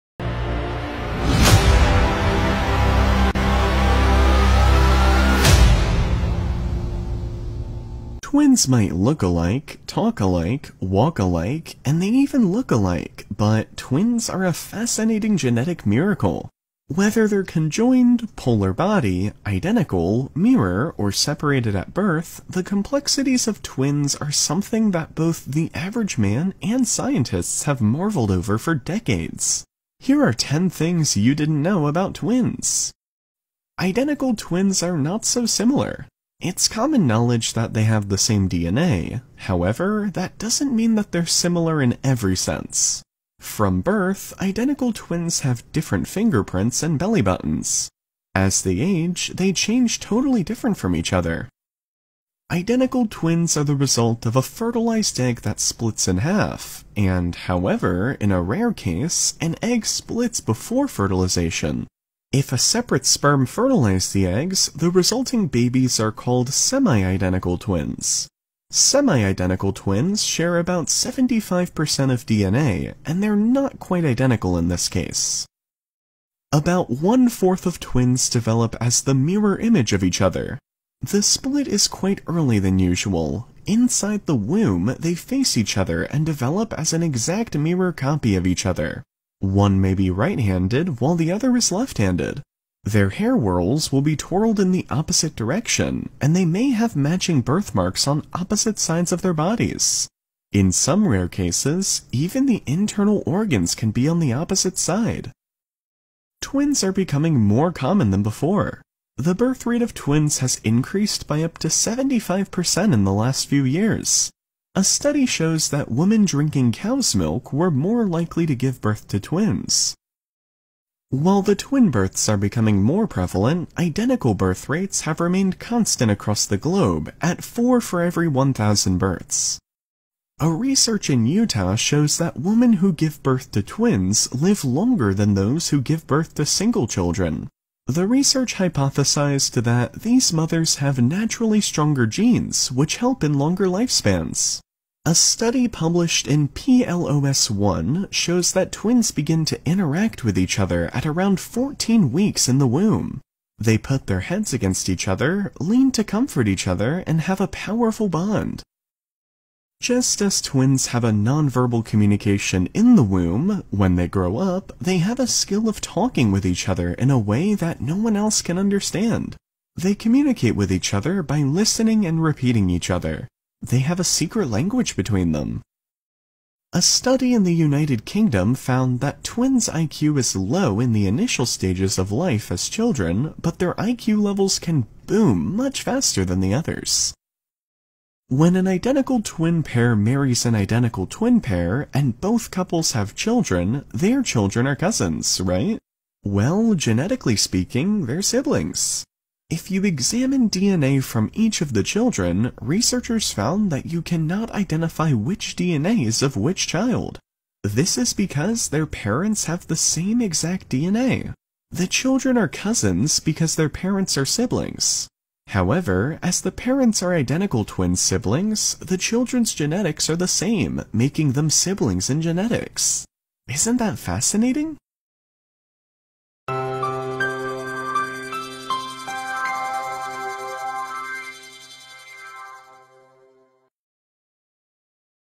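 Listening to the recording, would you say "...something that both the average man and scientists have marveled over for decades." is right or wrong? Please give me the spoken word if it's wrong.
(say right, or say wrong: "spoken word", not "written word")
right.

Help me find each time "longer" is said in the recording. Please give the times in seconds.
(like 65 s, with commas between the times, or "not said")
134 s, 143 s.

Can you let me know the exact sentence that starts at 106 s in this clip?
Twins are becoming more common than before.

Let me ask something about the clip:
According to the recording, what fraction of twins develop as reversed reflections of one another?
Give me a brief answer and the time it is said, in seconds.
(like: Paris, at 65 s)
one-fourth, at 76 s.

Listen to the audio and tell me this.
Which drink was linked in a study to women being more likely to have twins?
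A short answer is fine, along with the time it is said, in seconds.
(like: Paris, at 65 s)
cow's milk, at 116 s.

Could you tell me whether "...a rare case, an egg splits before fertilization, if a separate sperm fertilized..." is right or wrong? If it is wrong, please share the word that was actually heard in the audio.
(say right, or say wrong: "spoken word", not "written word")
right.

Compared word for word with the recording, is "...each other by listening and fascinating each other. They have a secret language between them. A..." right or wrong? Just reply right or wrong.
wrong.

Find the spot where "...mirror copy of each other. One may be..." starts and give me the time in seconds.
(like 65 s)
87 s.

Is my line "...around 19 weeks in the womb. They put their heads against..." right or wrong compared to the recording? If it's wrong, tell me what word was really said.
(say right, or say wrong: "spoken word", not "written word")
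wrong: "14", not "19".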